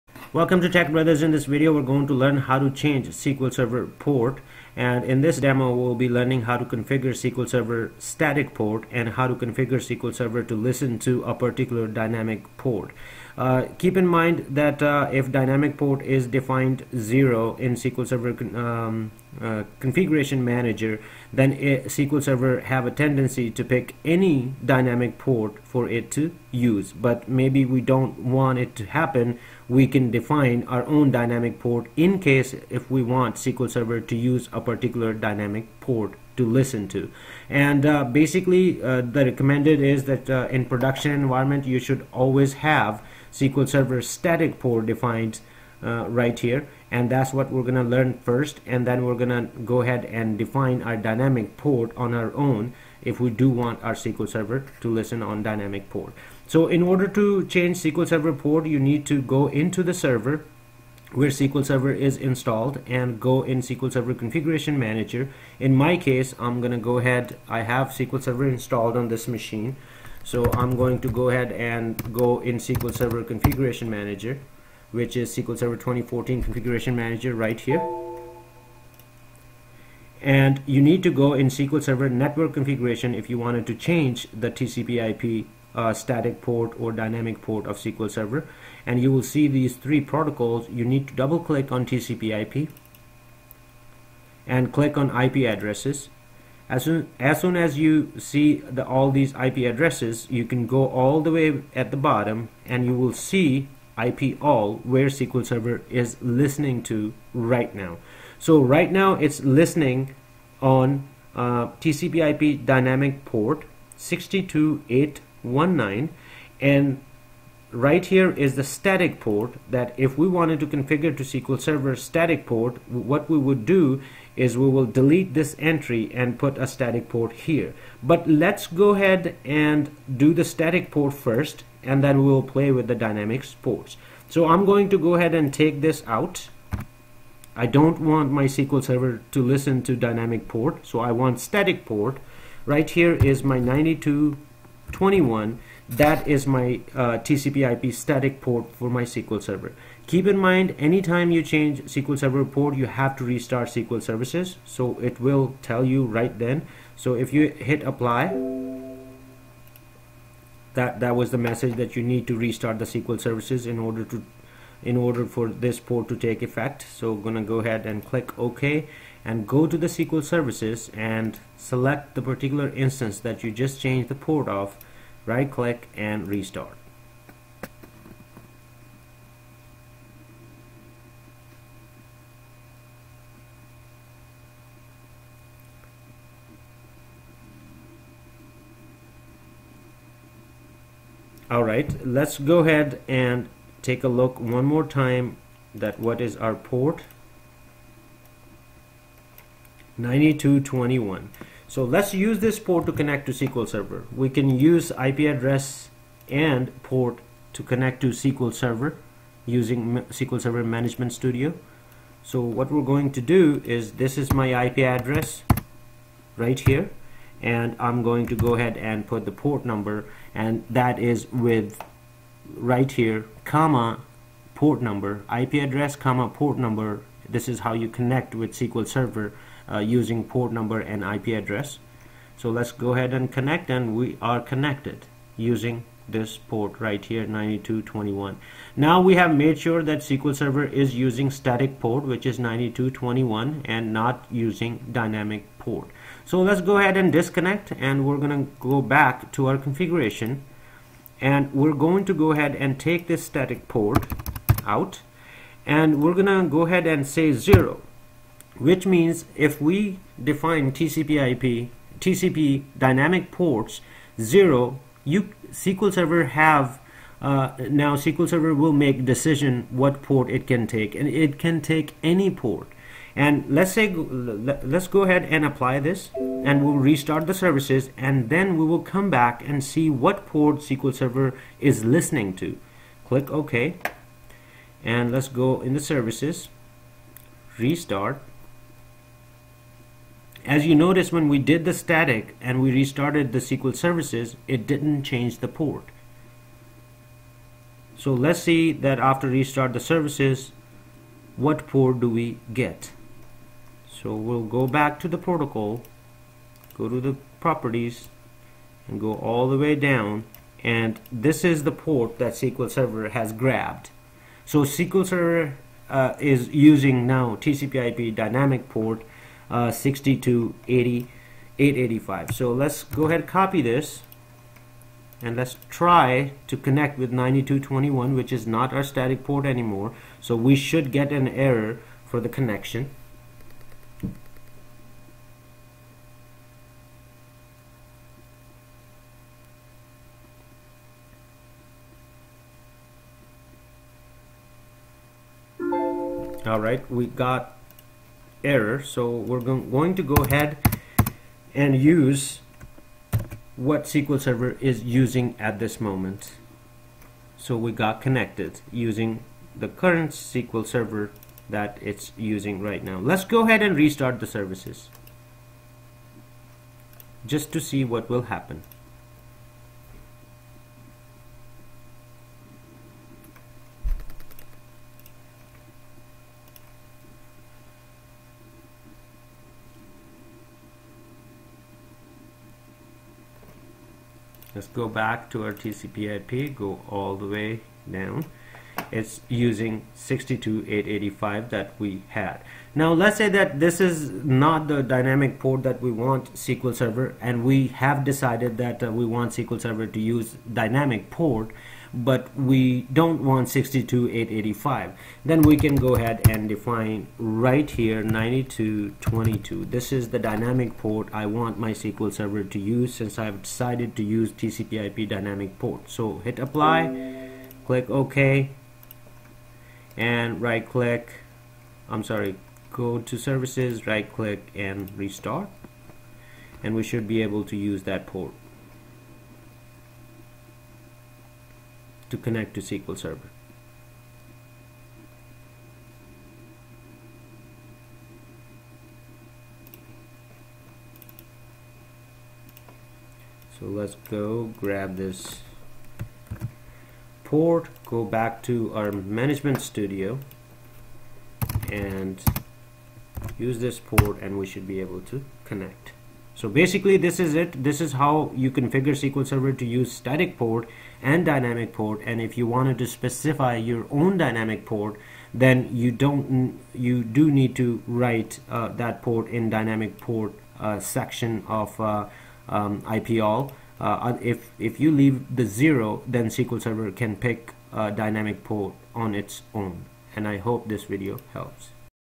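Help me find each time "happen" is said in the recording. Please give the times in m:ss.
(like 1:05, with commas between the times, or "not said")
0:28, 6:08.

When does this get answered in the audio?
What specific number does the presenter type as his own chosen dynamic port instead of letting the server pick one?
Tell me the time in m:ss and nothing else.
6:48.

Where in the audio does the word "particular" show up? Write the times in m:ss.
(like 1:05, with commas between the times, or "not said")
0:11, 0:34, 2:52.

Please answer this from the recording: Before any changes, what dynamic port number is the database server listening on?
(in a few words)
62819.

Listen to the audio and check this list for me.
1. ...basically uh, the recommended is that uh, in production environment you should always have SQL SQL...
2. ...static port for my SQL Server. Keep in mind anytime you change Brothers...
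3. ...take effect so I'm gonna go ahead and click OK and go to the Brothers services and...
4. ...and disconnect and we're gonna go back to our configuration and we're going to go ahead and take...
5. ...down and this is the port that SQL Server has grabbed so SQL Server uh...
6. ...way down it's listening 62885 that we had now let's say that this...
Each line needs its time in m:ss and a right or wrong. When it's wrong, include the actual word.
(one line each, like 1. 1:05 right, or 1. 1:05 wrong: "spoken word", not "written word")
1. 0:38 wrong: "Server", not "SQL"
2. 2:27 wrong: "SQL", not "Brothers"
3. 2:46 wrong: "SQL", not "Brothers"
4. 4:06 right
5. 5:09 right
6. 6:27 wrong: "using", not "listening".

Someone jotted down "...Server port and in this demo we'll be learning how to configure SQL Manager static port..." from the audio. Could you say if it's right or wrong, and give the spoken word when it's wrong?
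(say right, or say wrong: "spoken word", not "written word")
wrong: "Server", not "Manager".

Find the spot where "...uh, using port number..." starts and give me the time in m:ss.
3:49.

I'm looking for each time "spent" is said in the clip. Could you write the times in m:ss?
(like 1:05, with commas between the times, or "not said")
not said.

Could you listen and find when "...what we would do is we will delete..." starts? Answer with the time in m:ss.
2:02.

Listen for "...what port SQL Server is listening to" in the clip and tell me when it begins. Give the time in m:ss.
4:39.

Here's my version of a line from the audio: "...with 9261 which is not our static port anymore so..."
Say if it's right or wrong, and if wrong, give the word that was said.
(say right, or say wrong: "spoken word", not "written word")
wrong: "9221", not "9261".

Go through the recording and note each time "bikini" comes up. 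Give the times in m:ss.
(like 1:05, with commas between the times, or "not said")
not said.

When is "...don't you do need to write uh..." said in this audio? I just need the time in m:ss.
7:45.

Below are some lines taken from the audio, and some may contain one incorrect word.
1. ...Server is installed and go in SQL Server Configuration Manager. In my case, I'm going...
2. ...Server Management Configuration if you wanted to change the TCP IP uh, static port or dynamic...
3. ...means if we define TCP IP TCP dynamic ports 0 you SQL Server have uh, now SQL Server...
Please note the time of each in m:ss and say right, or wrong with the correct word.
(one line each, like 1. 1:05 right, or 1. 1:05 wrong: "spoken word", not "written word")
1. 1:01 right
2. 1:21 wrong: "Network", not "Management"
3. 4:18 right.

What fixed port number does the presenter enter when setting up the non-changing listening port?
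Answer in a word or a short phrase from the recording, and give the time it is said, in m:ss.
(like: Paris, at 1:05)
9221, at 2:23.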